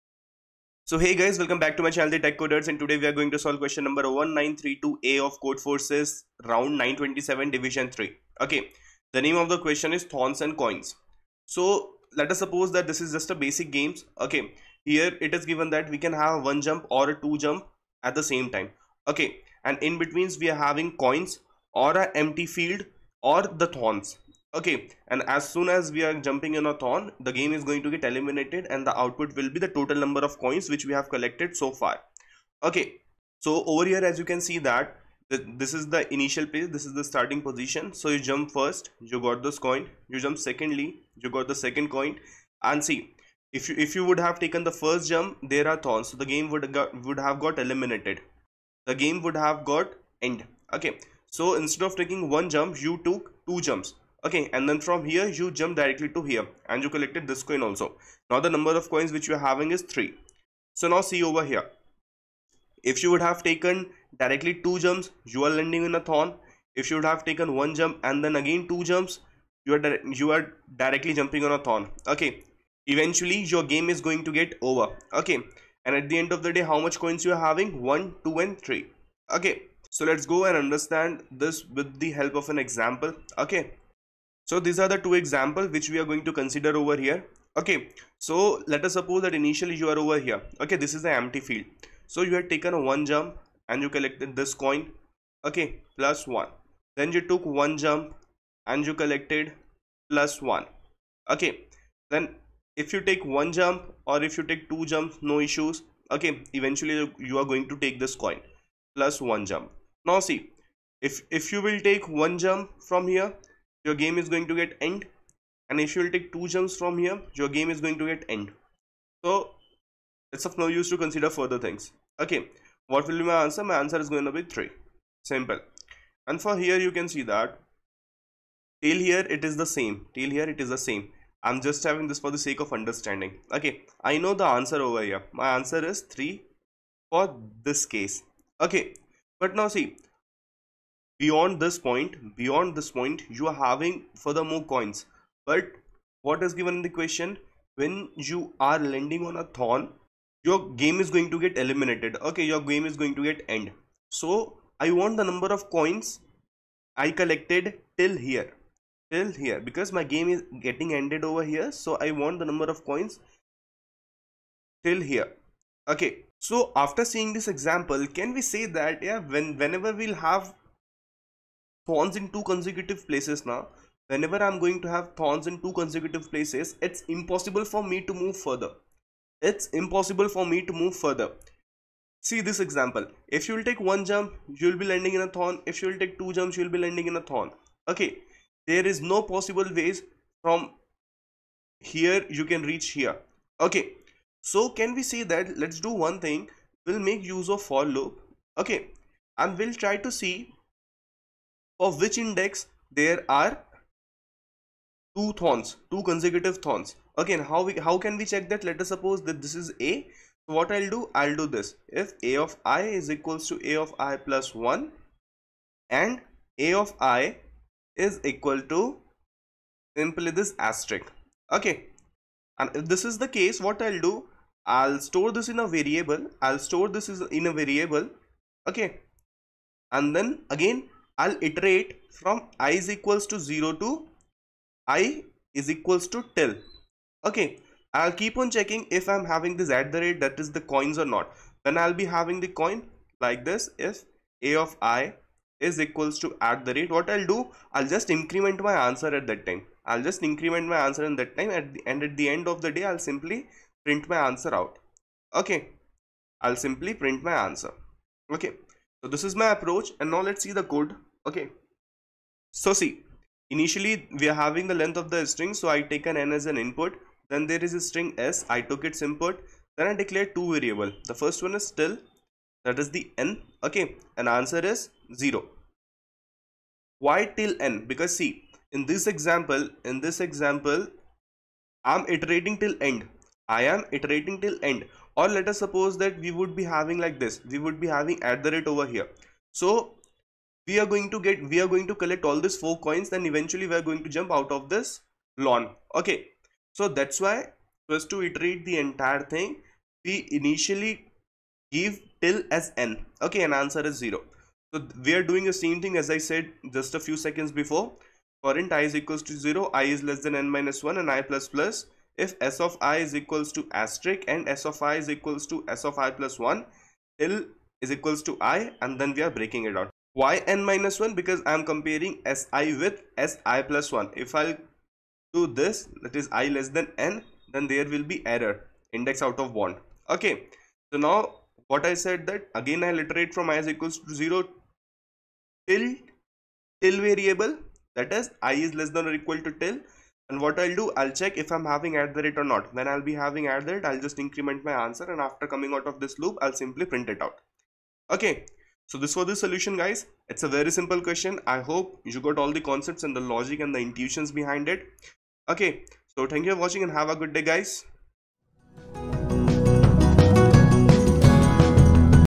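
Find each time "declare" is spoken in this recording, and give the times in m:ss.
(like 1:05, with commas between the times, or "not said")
4:29.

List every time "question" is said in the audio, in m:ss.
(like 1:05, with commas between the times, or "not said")
0:03, 0:09, 2:26, 5:50.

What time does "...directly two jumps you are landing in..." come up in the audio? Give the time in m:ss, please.
1:04.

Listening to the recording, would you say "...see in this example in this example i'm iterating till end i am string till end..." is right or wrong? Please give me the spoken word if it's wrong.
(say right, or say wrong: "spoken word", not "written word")
wrong: "iterating", not "string".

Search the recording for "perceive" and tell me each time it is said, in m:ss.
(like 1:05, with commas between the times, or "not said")
not said.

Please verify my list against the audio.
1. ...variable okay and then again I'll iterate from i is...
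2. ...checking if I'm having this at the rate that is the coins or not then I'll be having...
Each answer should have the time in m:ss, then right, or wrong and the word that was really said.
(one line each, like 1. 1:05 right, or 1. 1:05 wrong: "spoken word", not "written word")
1. 3:47 right
2. 3:58 right.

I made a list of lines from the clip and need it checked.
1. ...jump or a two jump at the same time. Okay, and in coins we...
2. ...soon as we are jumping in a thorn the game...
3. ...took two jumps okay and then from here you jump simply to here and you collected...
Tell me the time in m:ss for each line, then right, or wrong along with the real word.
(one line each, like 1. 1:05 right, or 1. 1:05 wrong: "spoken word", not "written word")
1. 0:16 wrong: "betweens", not "coins"
2. 0:25 right
3. 0:53 wrong: "directly", not "simply".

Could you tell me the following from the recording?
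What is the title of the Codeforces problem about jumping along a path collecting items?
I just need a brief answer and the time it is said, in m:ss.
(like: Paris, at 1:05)
Thorns and Coins, at 0:10.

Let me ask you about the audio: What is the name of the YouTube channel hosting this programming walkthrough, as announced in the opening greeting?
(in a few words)
The Tech Coders.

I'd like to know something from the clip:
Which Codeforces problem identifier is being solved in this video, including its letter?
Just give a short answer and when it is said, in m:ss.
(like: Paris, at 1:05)
1932A, at 0:04.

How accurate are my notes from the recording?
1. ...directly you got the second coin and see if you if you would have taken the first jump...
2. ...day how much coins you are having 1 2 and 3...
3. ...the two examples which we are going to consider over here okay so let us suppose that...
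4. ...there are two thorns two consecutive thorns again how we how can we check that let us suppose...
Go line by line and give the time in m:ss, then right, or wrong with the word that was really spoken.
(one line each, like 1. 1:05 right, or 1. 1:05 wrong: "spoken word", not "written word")
1. 0:40 wrong: "secondly", not "directly"
2. 1:16 right
3. 1:24 right
4. 3:22 right.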